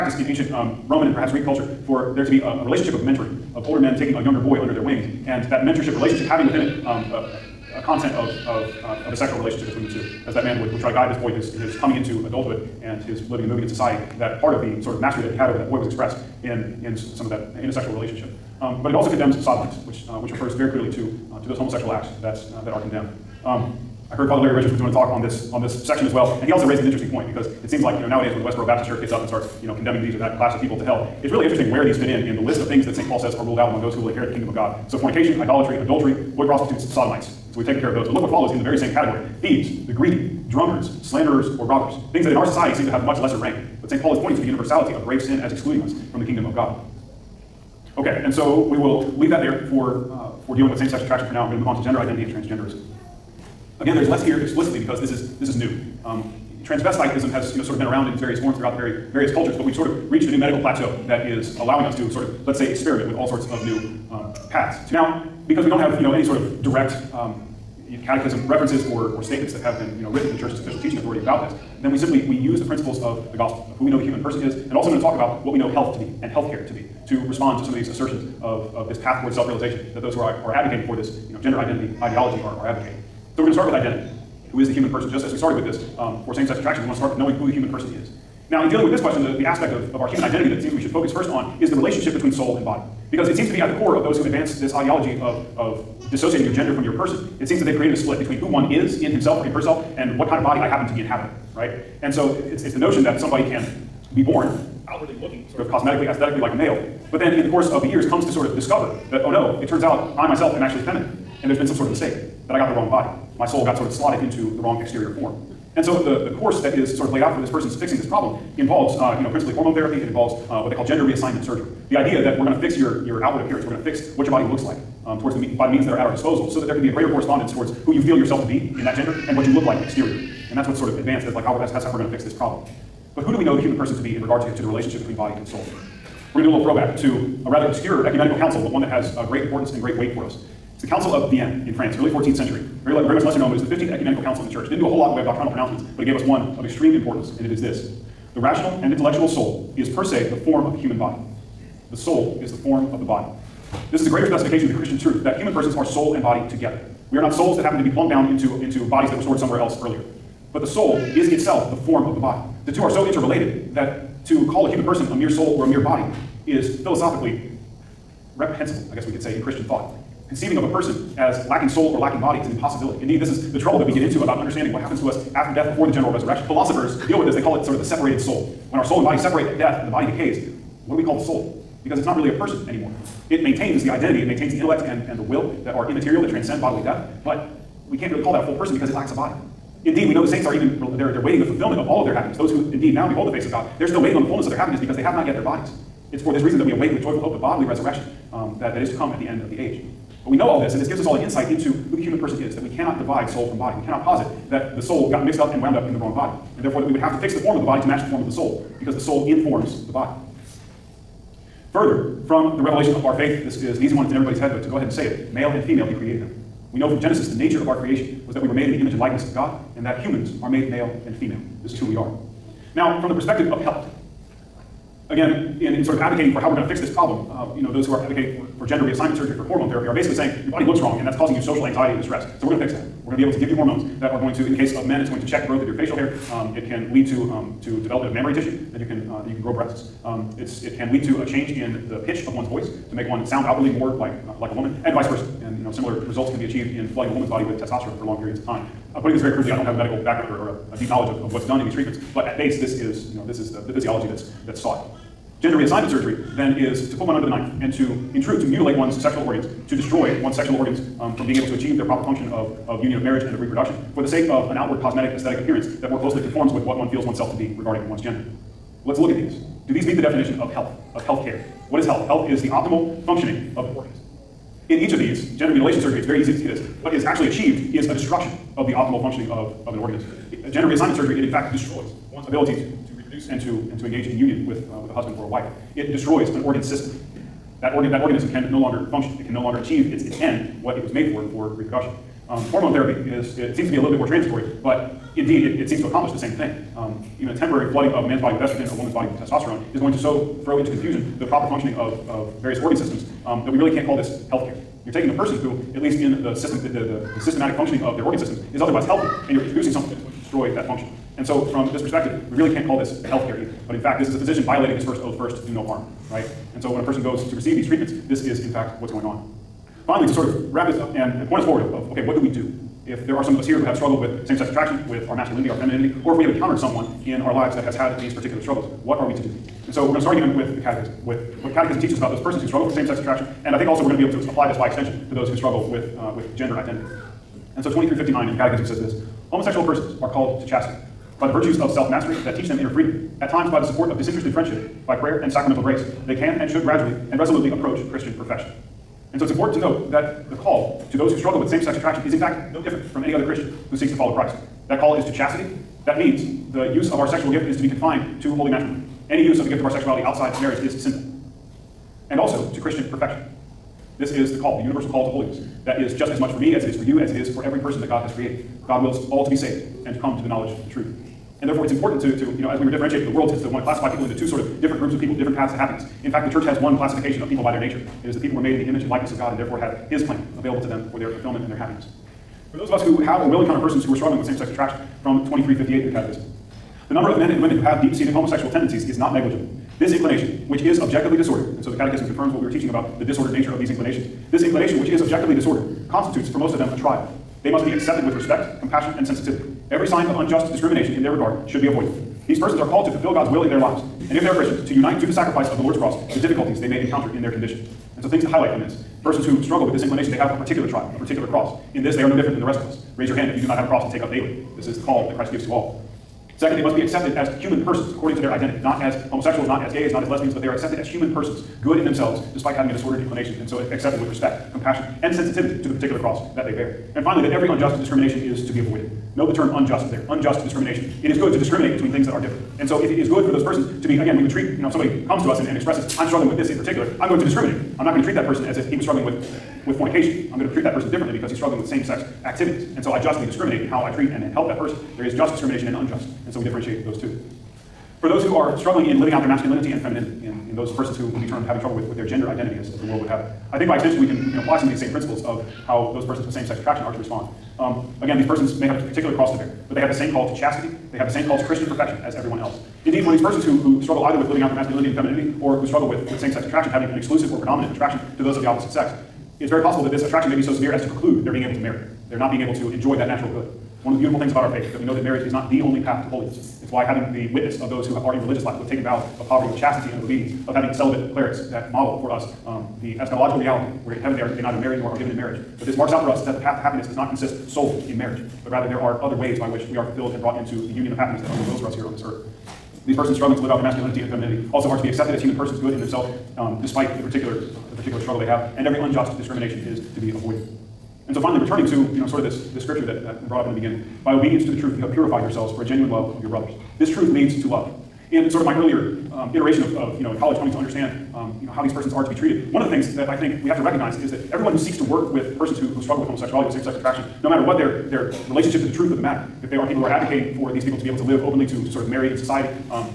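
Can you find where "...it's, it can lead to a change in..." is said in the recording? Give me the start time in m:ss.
4:00.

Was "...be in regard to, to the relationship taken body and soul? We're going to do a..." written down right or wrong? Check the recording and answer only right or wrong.
wrong.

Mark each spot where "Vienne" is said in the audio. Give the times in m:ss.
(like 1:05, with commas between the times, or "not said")
2:21.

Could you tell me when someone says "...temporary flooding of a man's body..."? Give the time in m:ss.
4:57.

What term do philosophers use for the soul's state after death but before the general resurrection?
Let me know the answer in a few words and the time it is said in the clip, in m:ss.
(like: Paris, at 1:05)
separated soul, at 2:57.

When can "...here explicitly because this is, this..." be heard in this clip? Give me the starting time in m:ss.
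0:54.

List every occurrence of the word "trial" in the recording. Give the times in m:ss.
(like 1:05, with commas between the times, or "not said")
6:36, 6:50.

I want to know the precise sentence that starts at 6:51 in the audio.
In this, they are no different than the rest of us.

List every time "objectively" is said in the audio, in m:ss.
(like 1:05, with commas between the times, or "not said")
6:30, 6:35.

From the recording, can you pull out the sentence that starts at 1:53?
My soul got sort of slotted into the wrong exterior form.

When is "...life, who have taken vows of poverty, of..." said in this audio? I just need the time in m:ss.
7:58.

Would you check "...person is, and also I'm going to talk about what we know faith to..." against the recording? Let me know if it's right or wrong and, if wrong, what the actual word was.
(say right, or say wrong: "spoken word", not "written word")
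wrong: "health", not "faith".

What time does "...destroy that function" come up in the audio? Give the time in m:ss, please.
5:10.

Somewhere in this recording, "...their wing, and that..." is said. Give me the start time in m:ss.
0:04.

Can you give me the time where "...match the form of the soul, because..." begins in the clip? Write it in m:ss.
3:27.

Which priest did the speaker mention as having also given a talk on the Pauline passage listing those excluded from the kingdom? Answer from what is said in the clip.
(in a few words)
Father Larry Richards.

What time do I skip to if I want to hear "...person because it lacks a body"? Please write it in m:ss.
3:08.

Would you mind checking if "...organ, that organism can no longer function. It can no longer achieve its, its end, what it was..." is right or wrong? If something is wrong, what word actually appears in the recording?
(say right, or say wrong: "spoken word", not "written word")
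right.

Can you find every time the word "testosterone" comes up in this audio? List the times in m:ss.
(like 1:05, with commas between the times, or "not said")
4:07, 4:59.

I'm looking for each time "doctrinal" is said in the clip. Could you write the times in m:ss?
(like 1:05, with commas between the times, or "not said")
2:25.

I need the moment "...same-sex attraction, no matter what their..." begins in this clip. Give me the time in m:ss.
8:36.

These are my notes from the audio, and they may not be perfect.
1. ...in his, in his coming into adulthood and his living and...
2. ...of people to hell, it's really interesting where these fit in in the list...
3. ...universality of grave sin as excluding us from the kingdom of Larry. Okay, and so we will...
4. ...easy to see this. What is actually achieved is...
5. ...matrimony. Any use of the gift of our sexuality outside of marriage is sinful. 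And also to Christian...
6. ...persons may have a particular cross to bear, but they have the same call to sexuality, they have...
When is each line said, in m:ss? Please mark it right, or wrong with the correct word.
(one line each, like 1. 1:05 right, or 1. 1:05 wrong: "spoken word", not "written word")
1. 0:11 right
2. 0:30 right
3. 0:44 wrong: "God", not "Larry"
4. 4:36 right
5. 5:58 right
6. 7:38 wrong: "chastity", not "sexuality".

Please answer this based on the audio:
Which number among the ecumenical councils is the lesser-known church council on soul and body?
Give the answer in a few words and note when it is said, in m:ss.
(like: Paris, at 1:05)
15th, at 2:23.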